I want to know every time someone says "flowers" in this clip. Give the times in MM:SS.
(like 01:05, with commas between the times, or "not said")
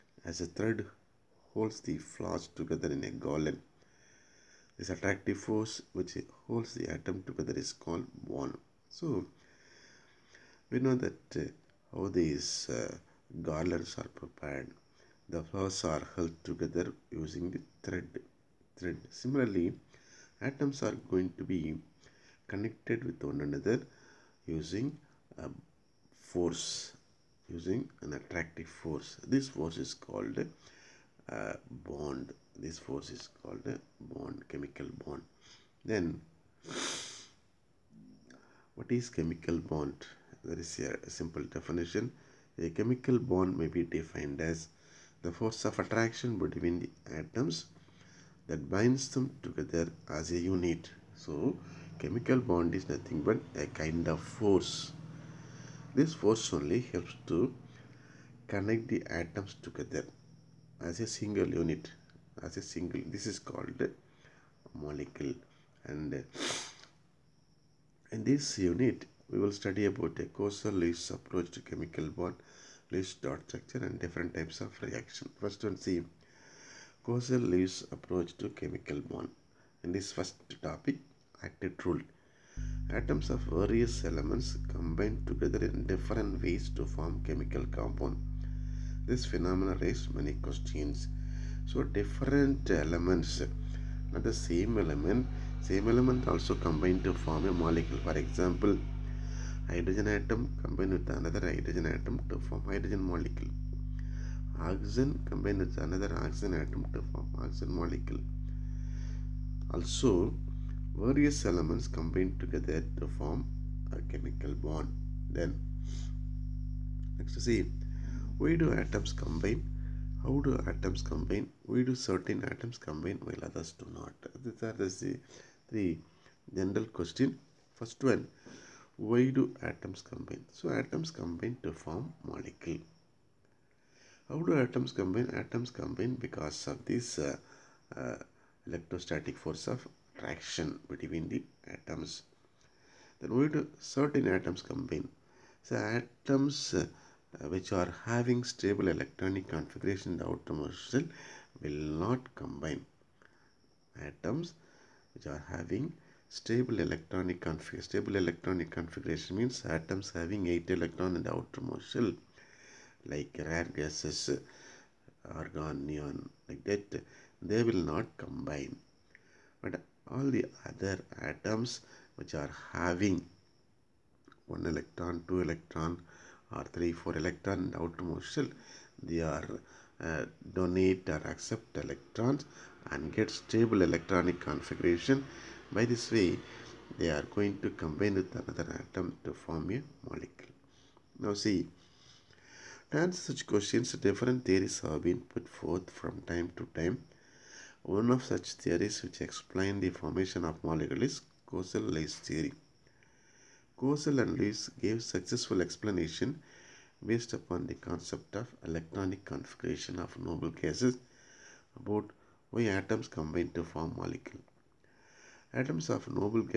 00:01, 00:15.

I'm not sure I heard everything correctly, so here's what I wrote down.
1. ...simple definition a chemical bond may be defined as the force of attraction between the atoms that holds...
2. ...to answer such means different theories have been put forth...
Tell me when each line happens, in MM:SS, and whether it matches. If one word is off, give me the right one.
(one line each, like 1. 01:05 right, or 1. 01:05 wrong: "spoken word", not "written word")
1. 00:41 wrong: "binds", not "holds"
2. 03:12 wrong: "questions", not "means".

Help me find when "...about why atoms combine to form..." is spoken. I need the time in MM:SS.
03:31.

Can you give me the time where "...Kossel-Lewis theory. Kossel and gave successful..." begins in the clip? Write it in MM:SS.
03:21.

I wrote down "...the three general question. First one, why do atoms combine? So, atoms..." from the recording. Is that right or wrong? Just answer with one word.
right.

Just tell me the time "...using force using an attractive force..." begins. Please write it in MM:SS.
00:24.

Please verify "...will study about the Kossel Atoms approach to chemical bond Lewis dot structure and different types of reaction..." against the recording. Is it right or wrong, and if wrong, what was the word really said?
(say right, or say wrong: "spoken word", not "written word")
wrong: "Lewis", not "Atoms".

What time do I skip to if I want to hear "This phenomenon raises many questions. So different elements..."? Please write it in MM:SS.
01:29.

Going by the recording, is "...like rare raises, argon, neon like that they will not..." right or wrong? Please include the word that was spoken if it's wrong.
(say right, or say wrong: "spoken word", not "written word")
wrong: "gases", not "raises".